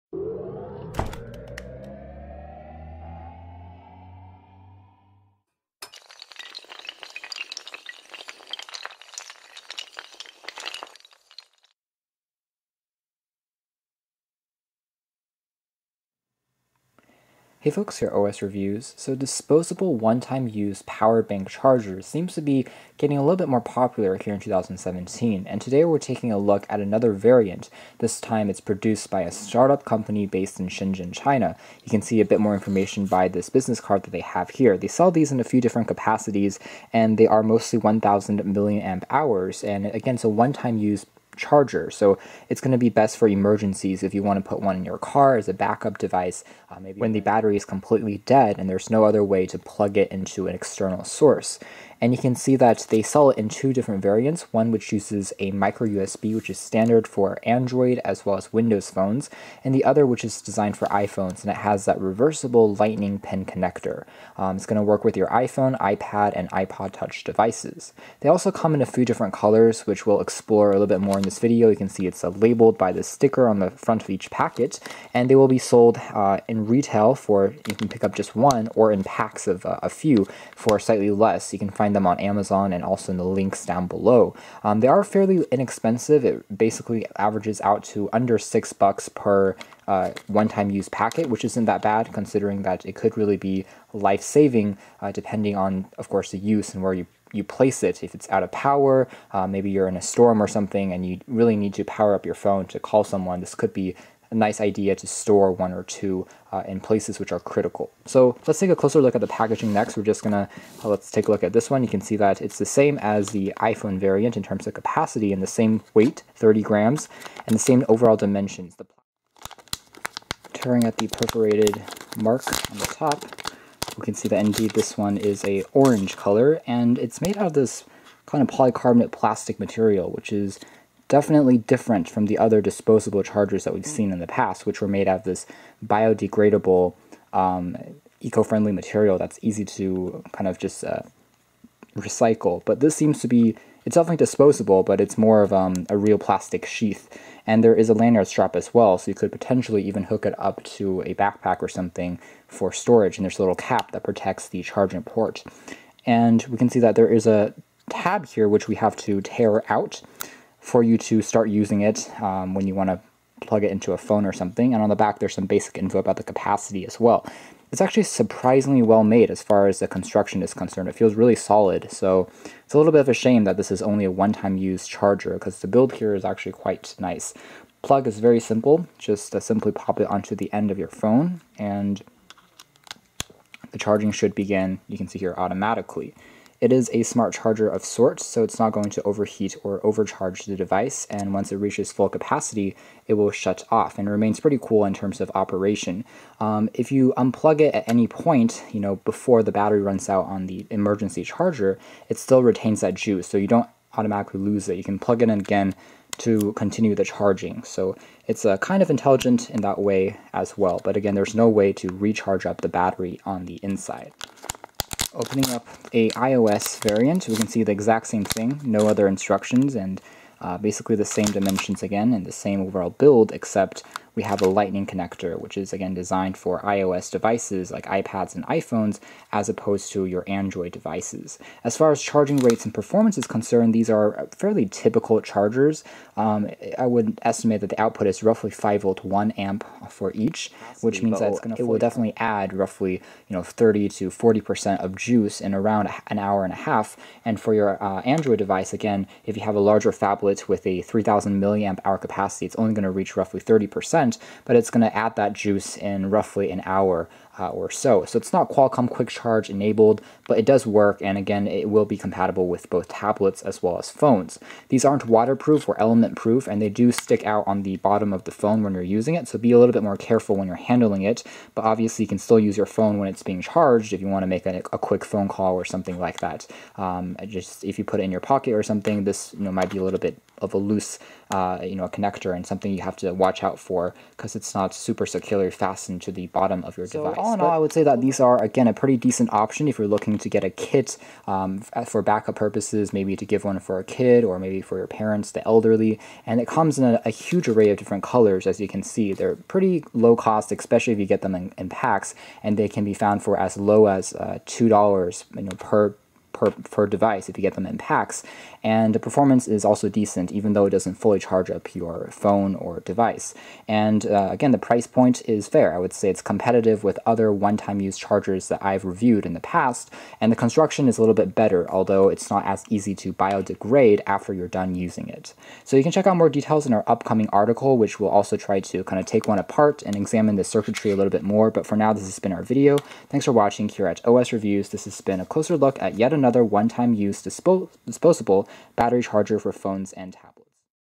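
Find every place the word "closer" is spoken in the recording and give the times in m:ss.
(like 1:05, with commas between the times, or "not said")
1:48, 5:35.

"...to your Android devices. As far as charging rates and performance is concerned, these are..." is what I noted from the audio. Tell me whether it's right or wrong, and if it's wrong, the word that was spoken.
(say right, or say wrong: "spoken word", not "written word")
right.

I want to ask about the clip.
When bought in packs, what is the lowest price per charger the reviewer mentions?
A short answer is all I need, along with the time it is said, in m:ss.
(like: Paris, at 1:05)
$2, at 5:04.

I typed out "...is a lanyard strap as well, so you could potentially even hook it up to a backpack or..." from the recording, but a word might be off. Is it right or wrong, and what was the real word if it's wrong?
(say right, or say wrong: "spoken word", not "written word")
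right.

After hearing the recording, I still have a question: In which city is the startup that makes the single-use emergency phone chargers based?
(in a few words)
Shenzhen.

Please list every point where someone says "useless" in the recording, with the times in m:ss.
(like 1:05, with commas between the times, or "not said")
not said.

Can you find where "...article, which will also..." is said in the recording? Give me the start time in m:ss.
5:27.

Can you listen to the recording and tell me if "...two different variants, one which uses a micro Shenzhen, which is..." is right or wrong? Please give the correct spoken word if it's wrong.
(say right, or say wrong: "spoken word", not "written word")
wrong: "USB", not "Shenzhen".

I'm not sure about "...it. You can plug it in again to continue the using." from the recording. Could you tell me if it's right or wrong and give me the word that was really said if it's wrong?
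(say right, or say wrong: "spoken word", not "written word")
wrong: "charging", not "using".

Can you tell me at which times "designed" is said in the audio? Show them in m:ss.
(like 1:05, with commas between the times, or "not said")
1:00, 3:45.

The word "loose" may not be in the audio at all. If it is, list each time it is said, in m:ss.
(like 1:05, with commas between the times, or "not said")
4:40.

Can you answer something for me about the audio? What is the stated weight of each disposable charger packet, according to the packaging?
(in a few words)
30 grams.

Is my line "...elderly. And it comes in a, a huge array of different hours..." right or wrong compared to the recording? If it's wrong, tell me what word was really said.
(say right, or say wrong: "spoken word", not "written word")
wrong: "colors", not "hours".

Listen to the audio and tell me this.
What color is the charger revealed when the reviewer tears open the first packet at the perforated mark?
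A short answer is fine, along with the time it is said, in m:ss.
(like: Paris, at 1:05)
orange, at 2:05.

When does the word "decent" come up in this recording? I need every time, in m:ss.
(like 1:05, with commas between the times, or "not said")
4:48, 5:09.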